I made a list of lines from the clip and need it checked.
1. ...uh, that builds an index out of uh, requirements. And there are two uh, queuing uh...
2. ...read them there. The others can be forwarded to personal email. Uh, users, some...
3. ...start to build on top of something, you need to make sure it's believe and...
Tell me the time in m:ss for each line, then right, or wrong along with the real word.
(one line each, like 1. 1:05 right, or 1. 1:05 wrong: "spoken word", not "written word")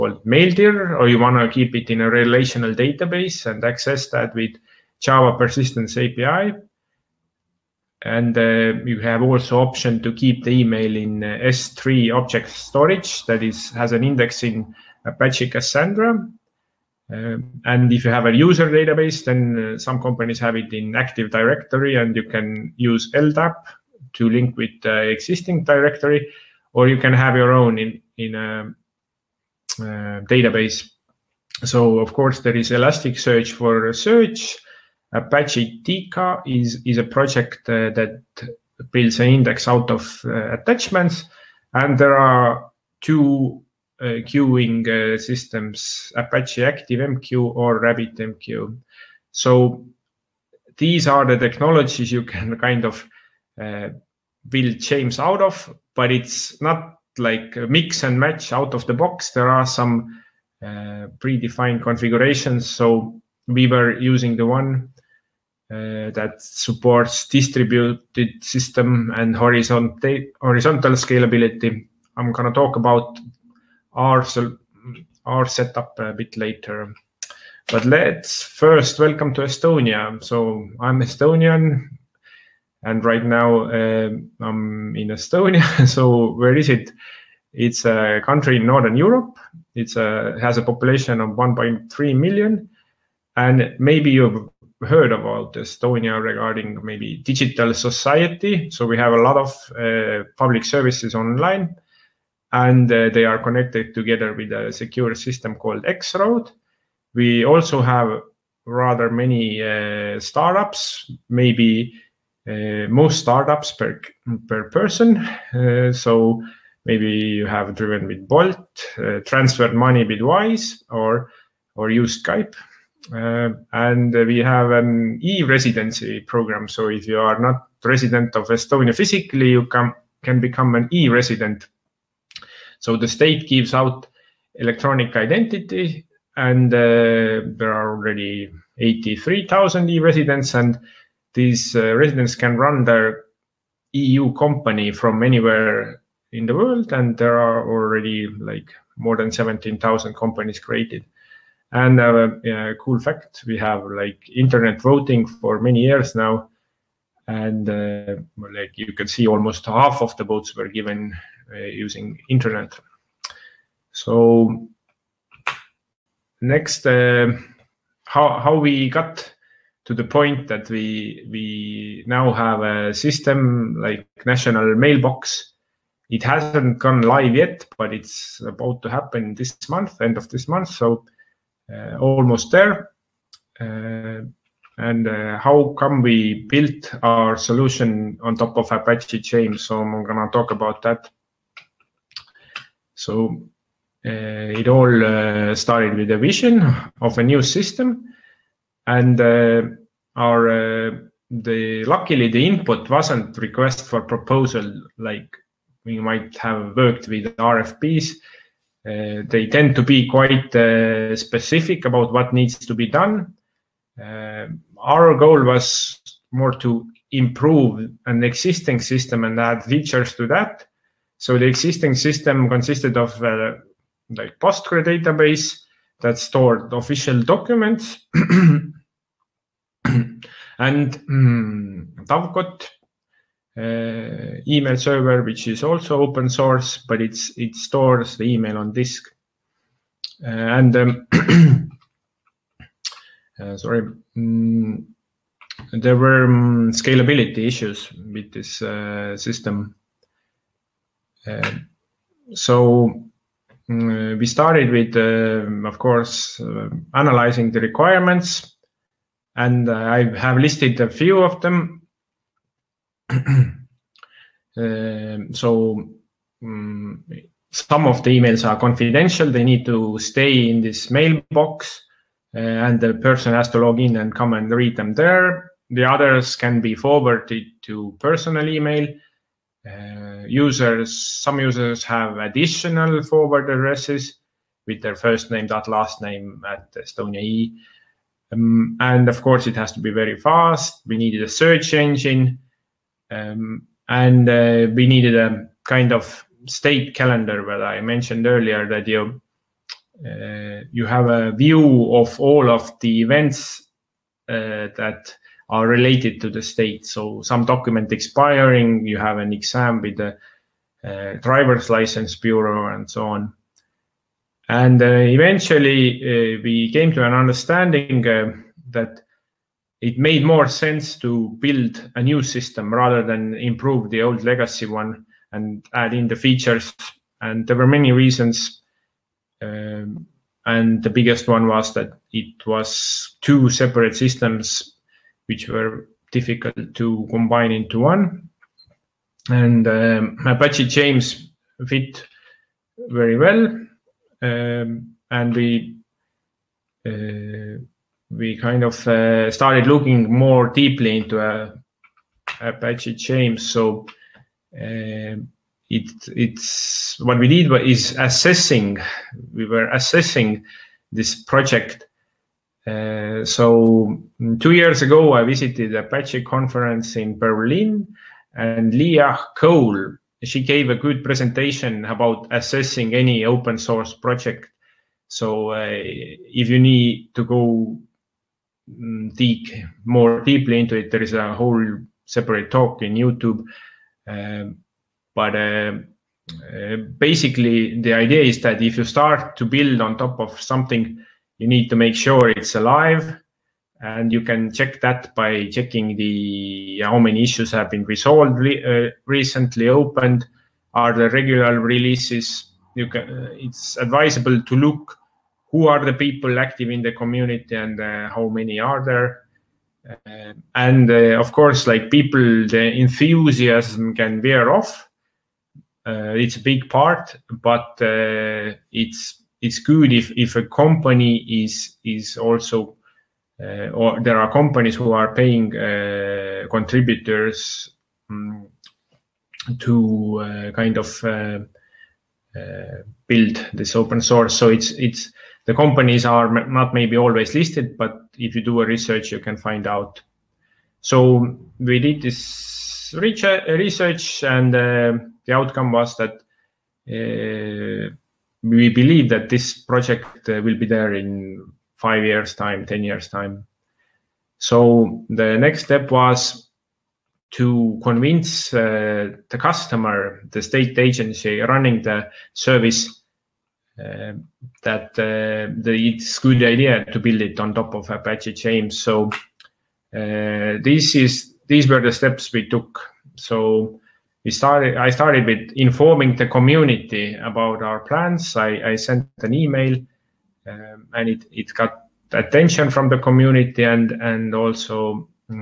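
1. 0:37 wrong: "attachments", not "requirements"
2. 4:34 right
3. 6:28 wrong: "alive", not "believe".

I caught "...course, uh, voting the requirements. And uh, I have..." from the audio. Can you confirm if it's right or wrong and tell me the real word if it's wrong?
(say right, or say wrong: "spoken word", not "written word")
wrong: "analyzing", not "voting".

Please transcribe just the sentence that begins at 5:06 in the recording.
So some document expiring, you have an exam with the uh, driver's license bureau and so on.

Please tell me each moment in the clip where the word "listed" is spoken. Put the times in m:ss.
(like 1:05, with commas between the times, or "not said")
4:20, 7:17.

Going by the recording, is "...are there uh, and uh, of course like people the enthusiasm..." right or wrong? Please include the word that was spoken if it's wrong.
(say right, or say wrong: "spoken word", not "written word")
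right.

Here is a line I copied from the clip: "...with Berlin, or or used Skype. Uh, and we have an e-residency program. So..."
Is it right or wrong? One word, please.
wrong.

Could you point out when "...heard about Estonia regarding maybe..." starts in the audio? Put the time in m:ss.
1:34.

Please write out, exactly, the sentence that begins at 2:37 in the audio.
And uh, like you can see almost half of the votes were given uh, using internet.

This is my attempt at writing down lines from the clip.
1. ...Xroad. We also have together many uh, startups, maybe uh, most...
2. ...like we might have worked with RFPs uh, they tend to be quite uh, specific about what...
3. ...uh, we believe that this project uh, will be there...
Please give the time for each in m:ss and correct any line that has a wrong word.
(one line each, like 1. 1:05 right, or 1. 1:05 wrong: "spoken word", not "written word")
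1. 1:45 wrong: "rather", not "together"
2. 3:24 right
3. 7:26 right.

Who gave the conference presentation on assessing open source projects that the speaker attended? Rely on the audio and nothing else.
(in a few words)
Leah Cole.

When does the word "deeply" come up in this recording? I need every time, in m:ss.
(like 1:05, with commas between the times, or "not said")
5:50, 6:20.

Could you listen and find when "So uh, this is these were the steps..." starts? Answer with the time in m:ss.
7:48.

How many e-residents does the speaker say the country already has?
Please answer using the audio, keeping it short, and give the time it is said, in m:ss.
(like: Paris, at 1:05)
83,000, at 2:18.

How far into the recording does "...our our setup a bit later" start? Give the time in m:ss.
1:13.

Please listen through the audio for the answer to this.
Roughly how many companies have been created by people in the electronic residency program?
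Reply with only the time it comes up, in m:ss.
2:29.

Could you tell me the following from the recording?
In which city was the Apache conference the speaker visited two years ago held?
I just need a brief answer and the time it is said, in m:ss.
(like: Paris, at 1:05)
Berlin, at 6:07.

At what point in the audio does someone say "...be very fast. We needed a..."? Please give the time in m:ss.
4:49.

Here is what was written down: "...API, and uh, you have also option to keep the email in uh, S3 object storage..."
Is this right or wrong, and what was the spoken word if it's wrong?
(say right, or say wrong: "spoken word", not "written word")
right.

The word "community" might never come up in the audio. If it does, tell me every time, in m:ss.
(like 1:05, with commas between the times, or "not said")
6:46, 7:56, 8:02.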